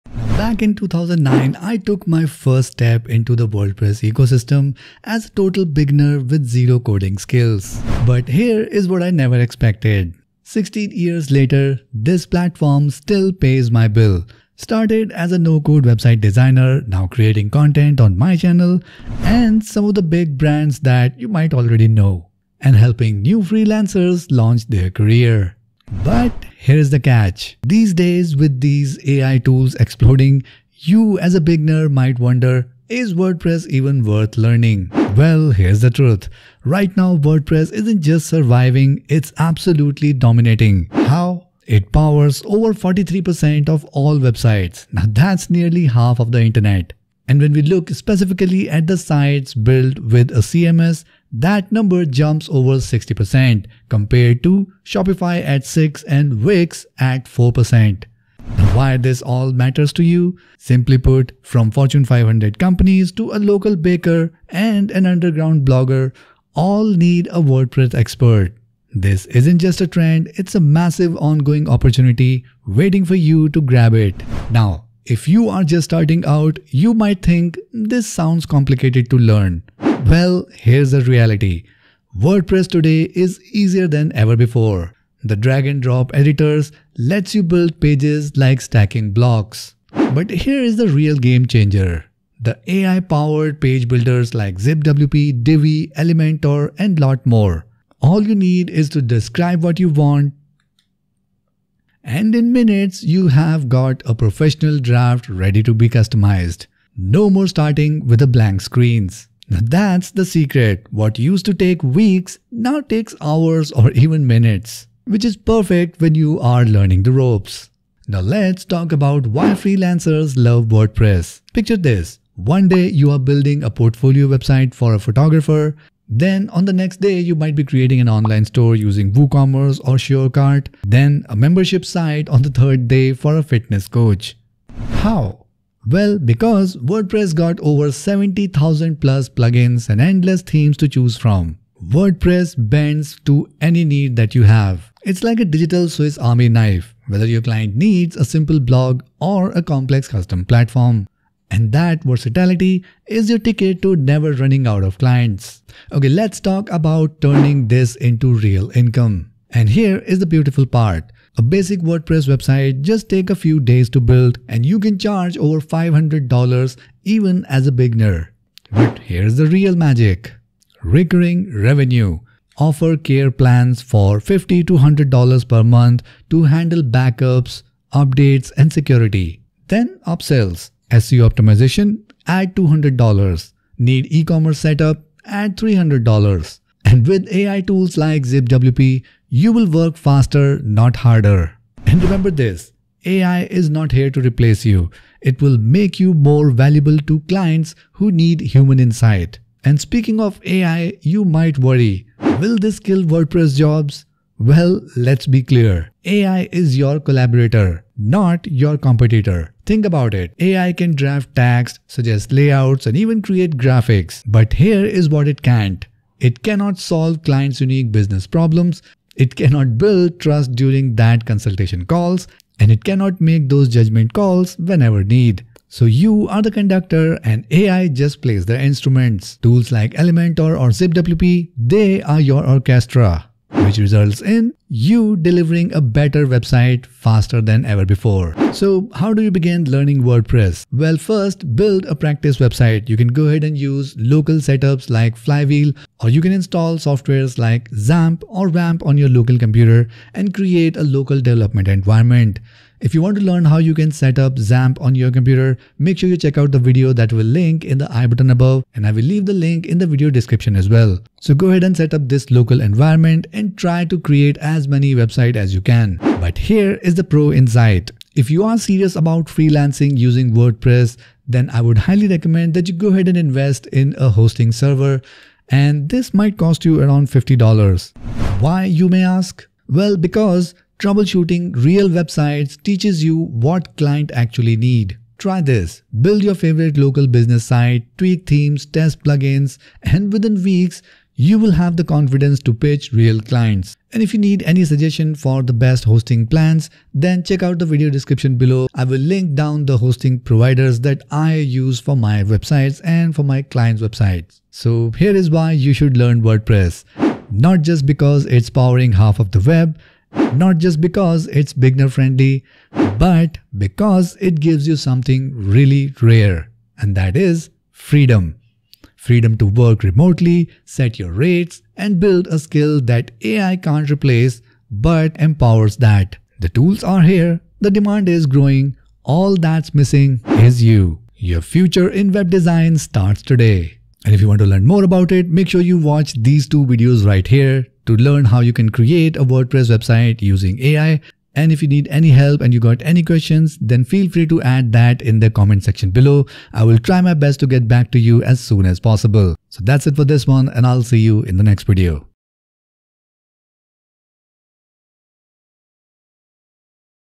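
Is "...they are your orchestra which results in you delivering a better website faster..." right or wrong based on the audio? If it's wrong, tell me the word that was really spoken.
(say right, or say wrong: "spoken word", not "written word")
right.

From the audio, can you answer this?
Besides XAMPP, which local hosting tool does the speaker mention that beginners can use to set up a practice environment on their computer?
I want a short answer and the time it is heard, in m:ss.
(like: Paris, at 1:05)
Flywheel, at 4:05.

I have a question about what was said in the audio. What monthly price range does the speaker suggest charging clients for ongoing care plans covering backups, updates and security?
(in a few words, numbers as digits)
$50 to $100.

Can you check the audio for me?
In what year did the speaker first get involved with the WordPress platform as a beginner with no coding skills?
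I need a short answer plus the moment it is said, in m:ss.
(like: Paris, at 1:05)
2009, at 0:00.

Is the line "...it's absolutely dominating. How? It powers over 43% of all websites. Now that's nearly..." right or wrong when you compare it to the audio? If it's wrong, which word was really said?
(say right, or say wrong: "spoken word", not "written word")
right.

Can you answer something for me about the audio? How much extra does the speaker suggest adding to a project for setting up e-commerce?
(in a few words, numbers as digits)
$300.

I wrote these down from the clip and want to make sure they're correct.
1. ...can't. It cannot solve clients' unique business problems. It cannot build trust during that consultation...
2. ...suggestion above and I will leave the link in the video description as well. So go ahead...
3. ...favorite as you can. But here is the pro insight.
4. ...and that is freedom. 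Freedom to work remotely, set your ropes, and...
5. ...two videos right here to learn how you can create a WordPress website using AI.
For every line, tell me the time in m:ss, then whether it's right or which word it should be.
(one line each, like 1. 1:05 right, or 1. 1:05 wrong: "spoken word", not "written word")
1. 3:35 right
2. 4:18 wrong: "button", not "suggestion"
3. 4:24 wrong: "website", not "favorite"
4. 5:16 wrong: "rates", not "ropes"
5. 5:36 right.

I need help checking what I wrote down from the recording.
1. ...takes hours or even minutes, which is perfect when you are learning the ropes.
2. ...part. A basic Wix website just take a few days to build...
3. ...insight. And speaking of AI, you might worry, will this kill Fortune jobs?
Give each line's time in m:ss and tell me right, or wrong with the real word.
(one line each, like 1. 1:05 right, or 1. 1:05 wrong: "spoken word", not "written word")
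1. 1:52 right
2. 2:40 wrong: "WordPress", not "Wix"
3. 3:18 wrong: "WordPress", not "Fortune".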